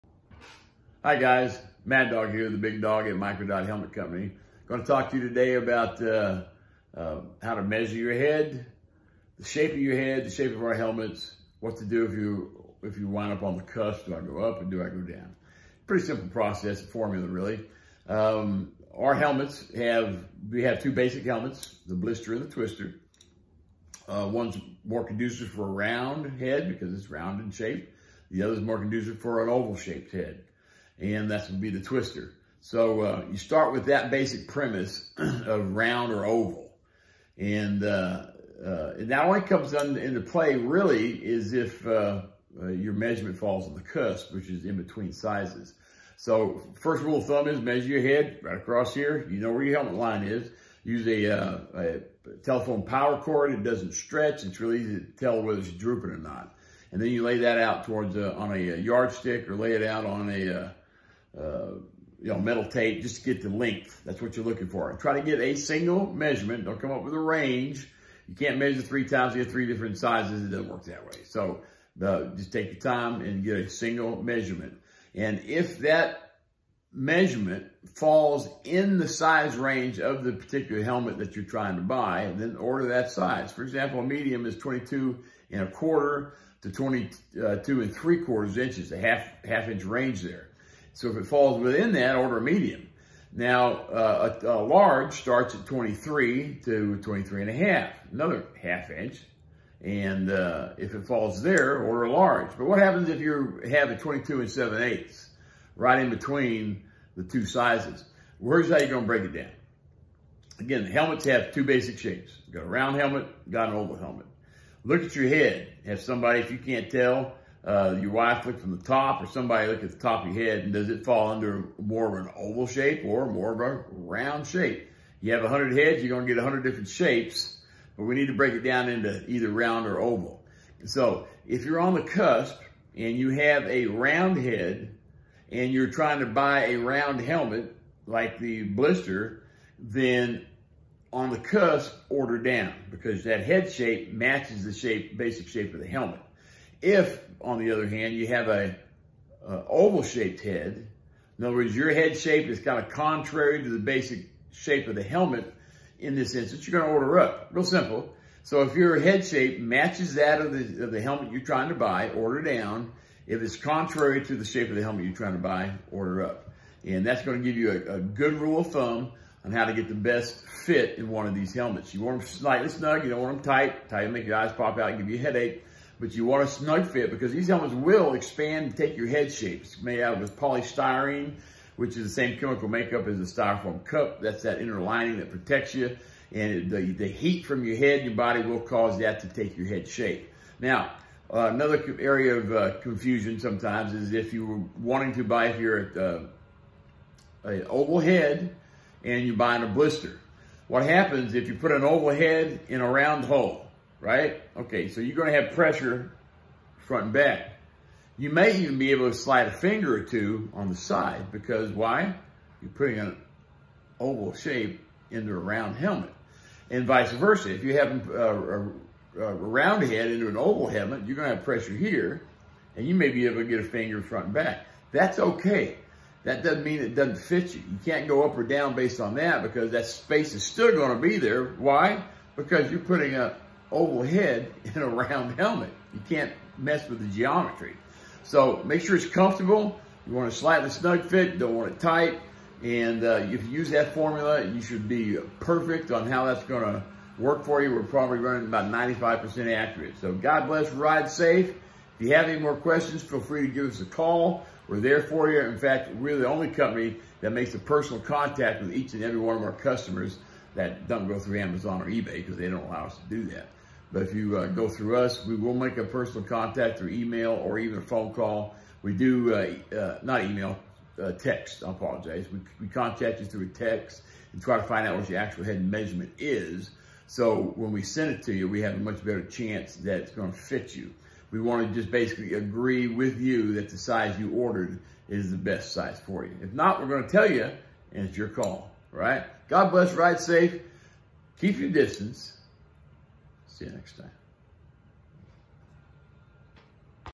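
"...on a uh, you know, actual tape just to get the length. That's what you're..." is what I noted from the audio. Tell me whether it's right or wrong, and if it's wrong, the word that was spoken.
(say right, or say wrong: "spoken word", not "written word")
wrong: "metal", not "actual".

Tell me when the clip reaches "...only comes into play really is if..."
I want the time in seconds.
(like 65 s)
39 s.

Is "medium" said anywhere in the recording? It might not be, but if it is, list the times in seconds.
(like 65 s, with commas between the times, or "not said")
84 s, 92 s.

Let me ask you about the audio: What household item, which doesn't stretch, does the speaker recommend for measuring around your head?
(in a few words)
Telephone power cord.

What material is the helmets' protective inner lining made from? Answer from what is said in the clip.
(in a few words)
Polystyrene.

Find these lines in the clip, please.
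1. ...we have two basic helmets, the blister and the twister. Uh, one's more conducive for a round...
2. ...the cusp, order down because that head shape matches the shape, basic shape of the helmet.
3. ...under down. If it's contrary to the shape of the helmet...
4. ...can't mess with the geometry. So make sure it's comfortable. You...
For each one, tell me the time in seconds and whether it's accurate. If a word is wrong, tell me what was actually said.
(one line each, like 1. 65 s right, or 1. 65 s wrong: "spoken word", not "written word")
1. 20 s right
2. 141 s right
3. 162 s wrong: "order", not "under"
4. 236 s right.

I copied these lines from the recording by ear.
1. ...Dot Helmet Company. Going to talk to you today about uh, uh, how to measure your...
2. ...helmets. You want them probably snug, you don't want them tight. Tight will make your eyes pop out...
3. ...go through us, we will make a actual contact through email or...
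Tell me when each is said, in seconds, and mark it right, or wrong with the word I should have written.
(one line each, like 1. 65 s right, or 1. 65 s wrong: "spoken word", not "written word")
1. 3 s right
2. 171 s wrong: "slightly", not "probably"
3. 264 s wrong: "personal", not "actual".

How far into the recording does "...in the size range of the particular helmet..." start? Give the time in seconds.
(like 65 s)
78 s.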